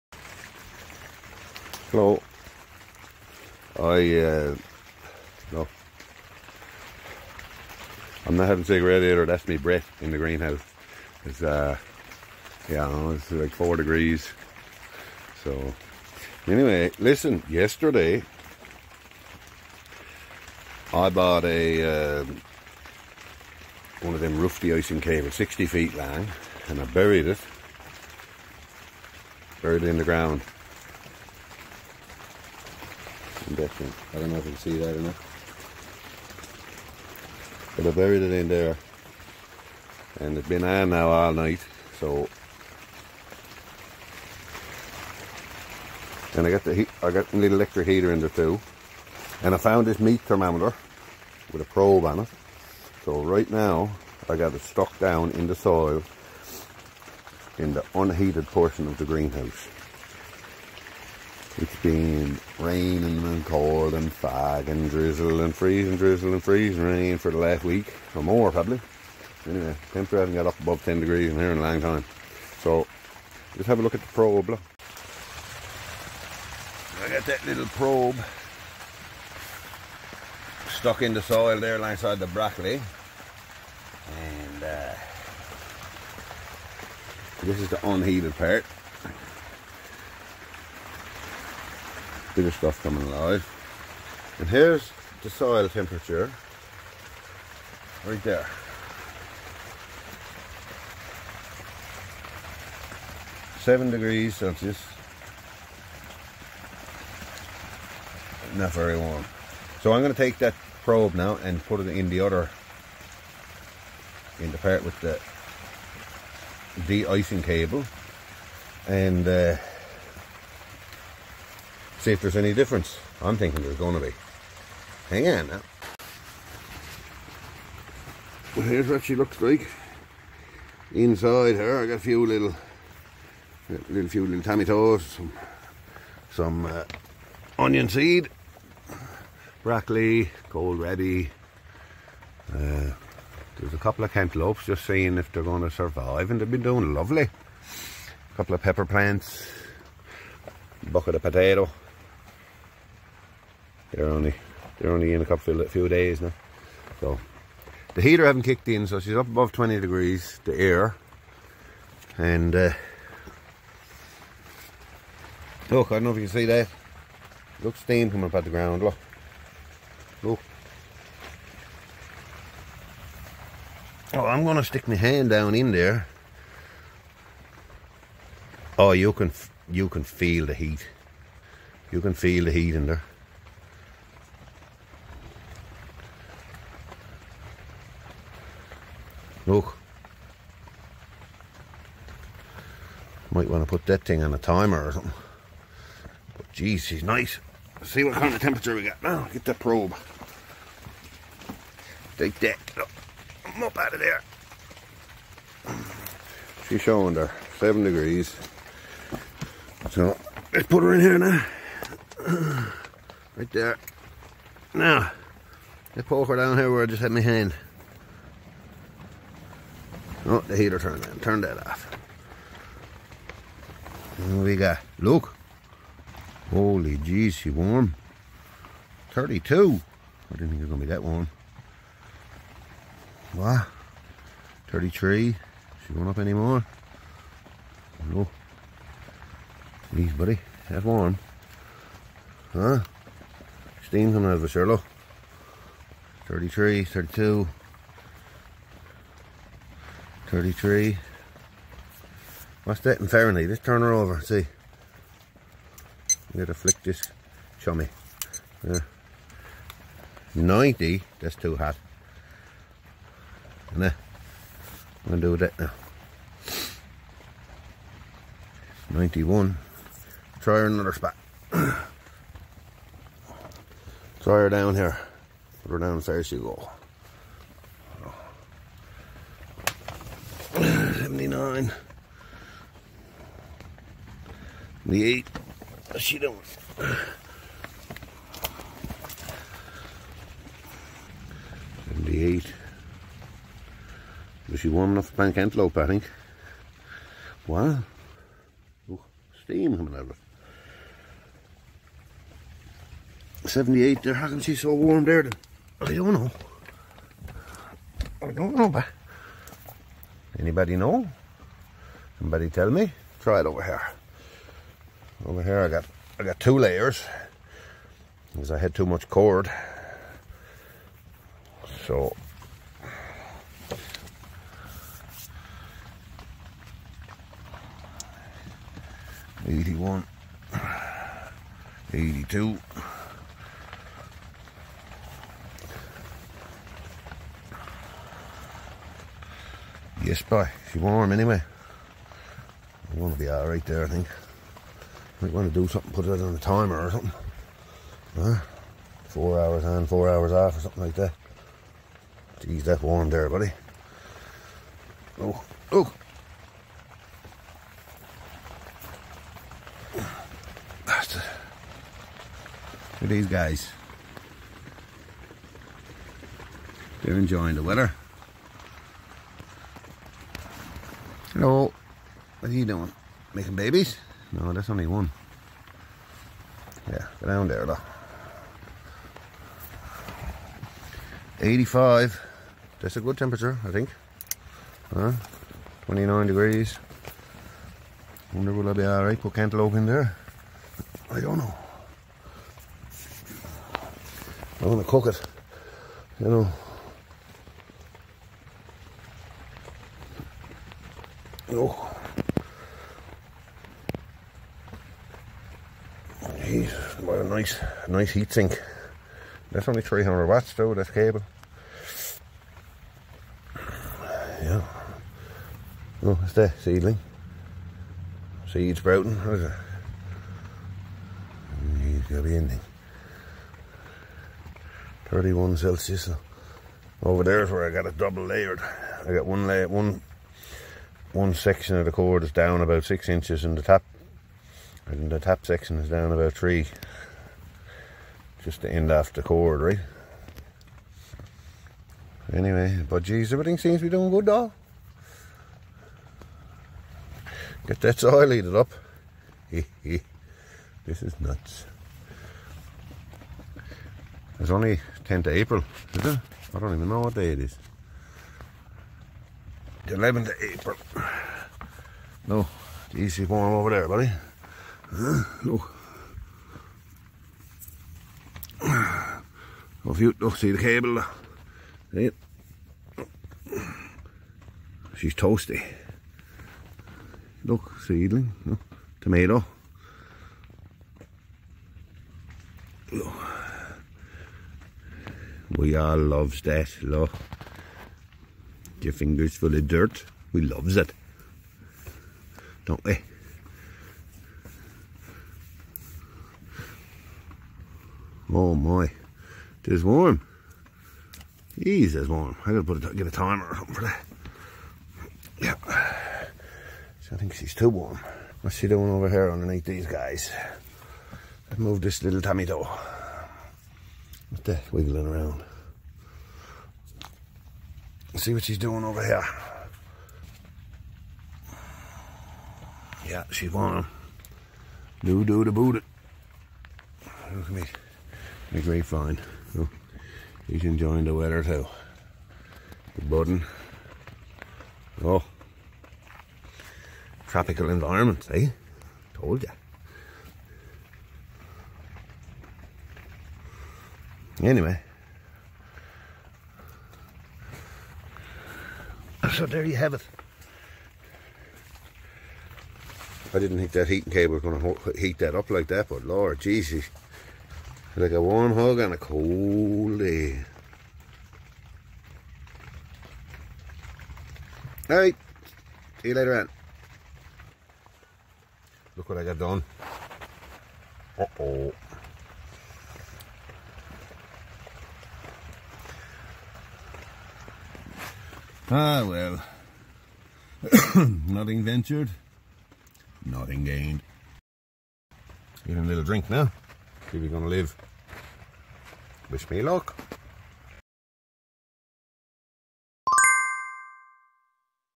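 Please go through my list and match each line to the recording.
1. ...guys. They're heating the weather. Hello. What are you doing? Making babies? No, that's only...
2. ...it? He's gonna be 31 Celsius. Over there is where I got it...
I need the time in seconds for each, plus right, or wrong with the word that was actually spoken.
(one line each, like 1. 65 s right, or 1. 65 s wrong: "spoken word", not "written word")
1. 363 s wrong: "enjoying", not "heating"
2. 419 s right.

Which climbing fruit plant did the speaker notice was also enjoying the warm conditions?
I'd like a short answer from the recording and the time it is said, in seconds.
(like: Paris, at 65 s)
Grapevine, at 528 s.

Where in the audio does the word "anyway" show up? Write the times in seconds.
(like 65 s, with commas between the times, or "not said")
16 s, 69 s, 341 s, 442 s, 544 s.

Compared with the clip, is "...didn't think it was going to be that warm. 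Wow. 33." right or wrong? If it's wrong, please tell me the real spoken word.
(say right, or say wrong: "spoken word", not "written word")
right.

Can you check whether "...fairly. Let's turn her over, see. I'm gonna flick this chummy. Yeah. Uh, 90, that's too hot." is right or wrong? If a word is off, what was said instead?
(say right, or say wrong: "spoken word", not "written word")
right.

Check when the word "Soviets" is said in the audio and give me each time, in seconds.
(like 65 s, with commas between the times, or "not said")
not said.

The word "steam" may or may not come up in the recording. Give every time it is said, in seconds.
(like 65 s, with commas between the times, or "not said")
167 s, 243 s, 299 s.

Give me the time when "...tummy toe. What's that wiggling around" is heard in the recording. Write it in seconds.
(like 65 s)
512 s.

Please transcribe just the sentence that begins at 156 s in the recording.
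So the heater haven't kicked in, so she's up above 20 degrees, the air.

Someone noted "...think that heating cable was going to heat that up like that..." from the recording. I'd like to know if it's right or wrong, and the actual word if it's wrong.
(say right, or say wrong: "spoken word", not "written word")
right.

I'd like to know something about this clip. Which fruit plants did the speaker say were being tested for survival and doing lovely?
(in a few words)
Cantaloupes.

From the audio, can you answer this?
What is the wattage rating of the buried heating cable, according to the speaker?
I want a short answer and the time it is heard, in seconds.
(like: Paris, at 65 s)
300 watts, at 409 s.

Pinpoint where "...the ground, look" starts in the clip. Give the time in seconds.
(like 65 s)
168 s.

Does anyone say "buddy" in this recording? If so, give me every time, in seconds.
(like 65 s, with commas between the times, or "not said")
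240 s, 353 s, 463 s.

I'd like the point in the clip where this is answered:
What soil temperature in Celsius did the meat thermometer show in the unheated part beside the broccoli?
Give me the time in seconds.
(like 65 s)
103 s.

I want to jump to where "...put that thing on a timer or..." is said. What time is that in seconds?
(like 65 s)
193 s.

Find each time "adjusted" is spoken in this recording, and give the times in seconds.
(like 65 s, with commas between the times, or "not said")
not said.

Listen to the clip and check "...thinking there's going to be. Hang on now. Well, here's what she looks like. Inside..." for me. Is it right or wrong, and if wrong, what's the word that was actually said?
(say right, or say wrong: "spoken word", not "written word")
right.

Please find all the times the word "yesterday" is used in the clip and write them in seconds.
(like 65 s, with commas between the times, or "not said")
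17 s.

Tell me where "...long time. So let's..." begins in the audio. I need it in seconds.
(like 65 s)
71 s.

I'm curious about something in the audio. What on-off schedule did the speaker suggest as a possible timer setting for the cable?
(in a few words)
4 hours on, 4 hours off.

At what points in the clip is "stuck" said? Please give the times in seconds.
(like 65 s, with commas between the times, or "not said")
54 s, 80 s.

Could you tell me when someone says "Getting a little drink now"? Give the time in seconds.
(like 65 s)
585 s.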